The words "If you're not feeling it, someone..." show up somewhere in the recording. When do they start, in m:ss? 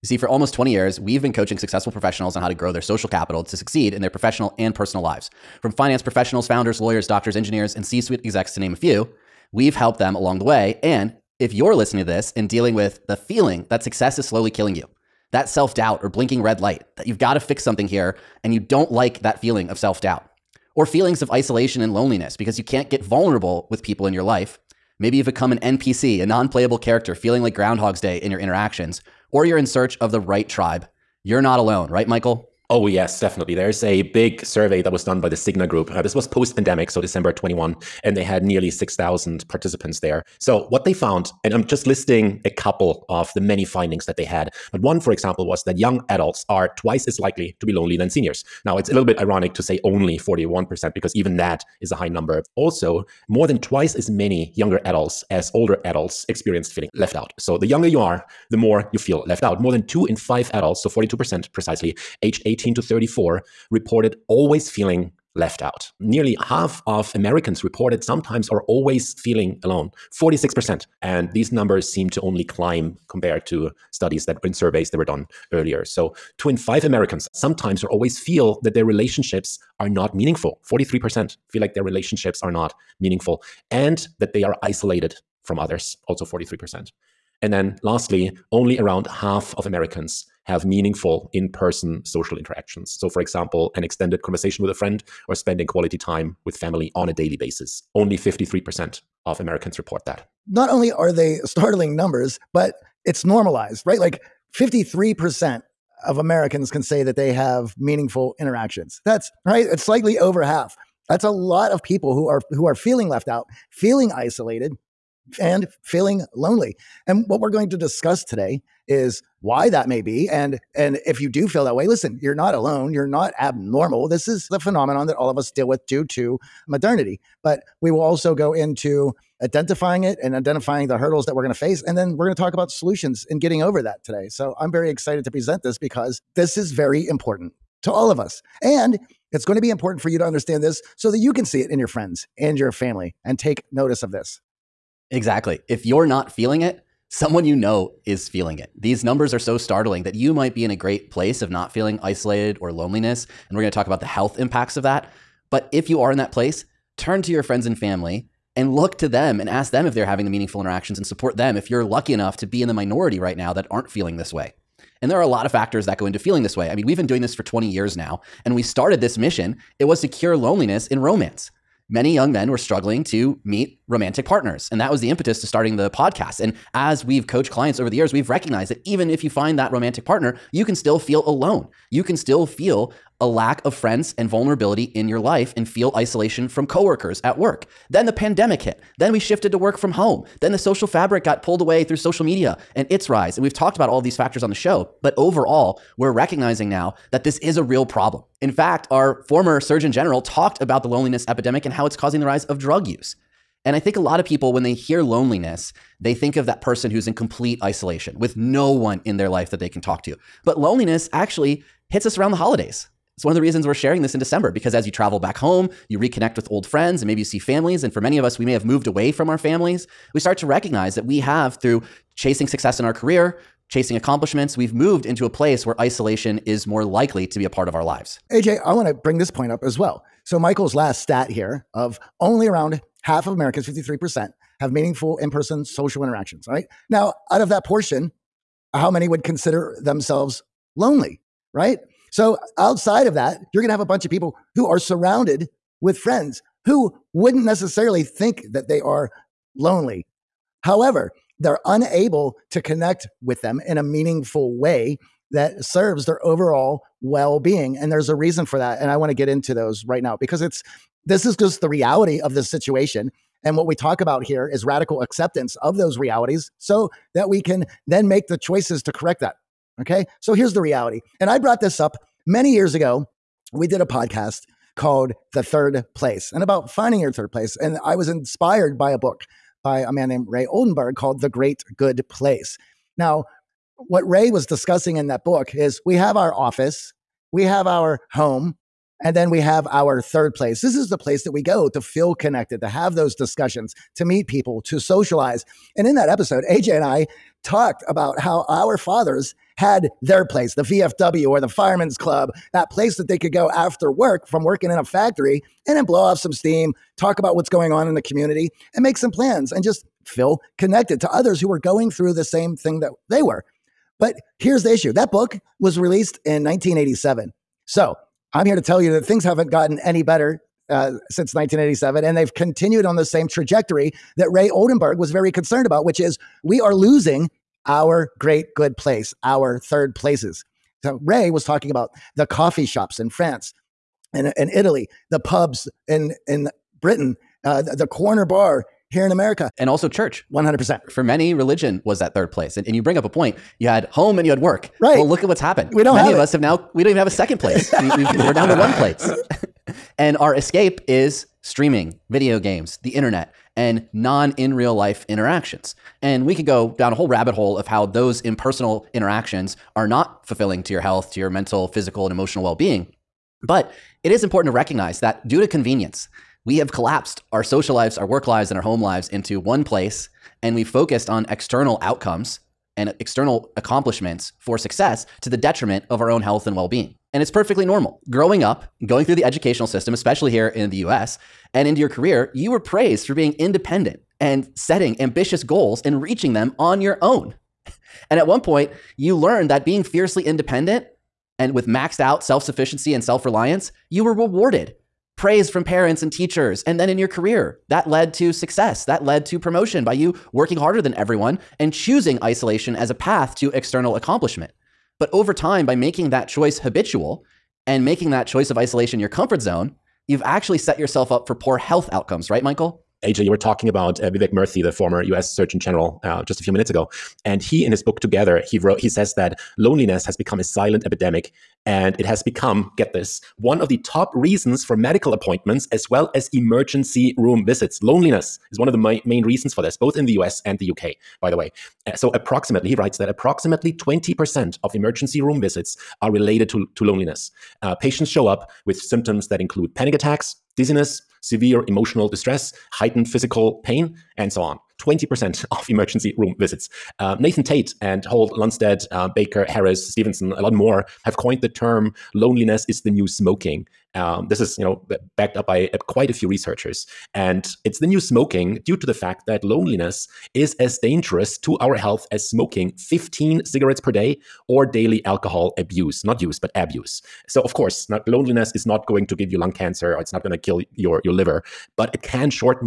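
2:25.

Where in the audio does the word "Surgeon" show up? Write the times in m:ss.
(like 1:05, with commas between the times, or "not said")
3:19, 6:55.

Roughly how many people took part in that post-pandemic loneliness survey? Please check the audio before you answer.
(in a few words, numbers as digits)
6,000.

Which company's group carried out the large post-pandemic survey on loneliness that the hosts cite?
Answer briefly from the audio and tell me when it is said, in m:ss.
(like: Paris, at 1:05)
Cigna, at 0:35.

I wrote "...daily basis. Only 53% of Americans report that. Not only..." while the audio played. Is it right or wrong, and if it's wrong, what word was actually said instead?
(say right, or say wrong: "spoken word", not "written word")
right.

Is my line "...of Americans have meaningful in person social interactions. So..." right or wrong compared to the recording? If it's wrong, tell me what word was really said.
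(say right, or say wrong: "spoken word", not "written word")
right.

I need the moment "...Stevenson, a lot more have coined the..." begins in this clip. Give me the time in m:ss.
7:29.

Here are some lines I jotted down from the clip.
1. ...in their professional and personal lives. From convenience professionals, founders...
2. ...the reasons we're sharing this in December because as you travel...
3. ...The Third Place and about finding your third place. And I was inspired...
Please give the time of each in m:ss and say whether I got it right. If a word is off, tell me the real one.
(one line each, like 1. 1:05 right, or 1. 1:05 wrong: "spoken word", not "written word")
1. 0:03 wrong: "finance", not "convenience"
2. 3:33 right
3. 4:35 right.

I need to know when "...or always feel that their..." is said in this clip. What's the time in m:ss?
1:17.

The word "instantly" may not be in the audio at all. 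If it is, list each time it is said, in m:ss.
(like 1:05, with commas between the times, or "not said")
not said.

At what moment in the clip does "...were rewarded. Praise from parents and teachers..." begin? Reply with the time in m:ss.
6:34.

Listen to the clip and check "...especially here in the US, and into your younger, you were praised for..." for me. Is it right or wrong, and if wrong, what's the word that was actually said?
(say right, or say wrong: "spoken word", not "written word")
wrong: "career", not "younger".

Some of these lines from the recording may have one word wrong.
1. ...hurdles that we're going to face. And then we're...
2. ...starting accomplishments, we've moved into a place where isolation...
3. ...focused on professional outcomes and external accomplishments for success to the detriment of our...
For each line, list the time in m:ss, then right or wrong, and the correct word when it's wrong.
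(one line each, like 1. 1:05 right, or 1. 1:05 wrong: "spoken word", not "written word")
1. 2:10 right
2. 3:43 wrong: "chasing", not "starting"
3. 6:10 wrong: "external", not "professional".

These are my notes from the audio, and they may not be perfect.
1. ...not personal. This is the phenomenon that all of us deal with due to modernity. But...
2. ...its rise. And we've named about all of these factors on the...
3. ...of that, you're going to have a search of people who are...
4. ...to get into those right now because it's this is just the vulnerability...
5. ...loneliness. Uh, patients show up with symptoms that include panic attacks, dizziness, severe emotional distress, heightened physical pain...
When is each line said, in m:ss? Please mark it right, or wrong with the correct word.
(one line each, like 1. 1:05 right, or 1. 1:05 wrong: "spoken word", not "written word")
1. 2:03 wrong: "abnormal", not "personal"
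2. 3:12 wrong: "talked", not "named"
3. 4:03 wrong: "bunch", not "search"
4. 4:19 wrong: "reality", not "vulnerability"
5. 7:16 right.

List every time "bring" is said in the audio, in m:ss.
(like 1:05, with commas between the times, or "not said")
3:48, 5:42.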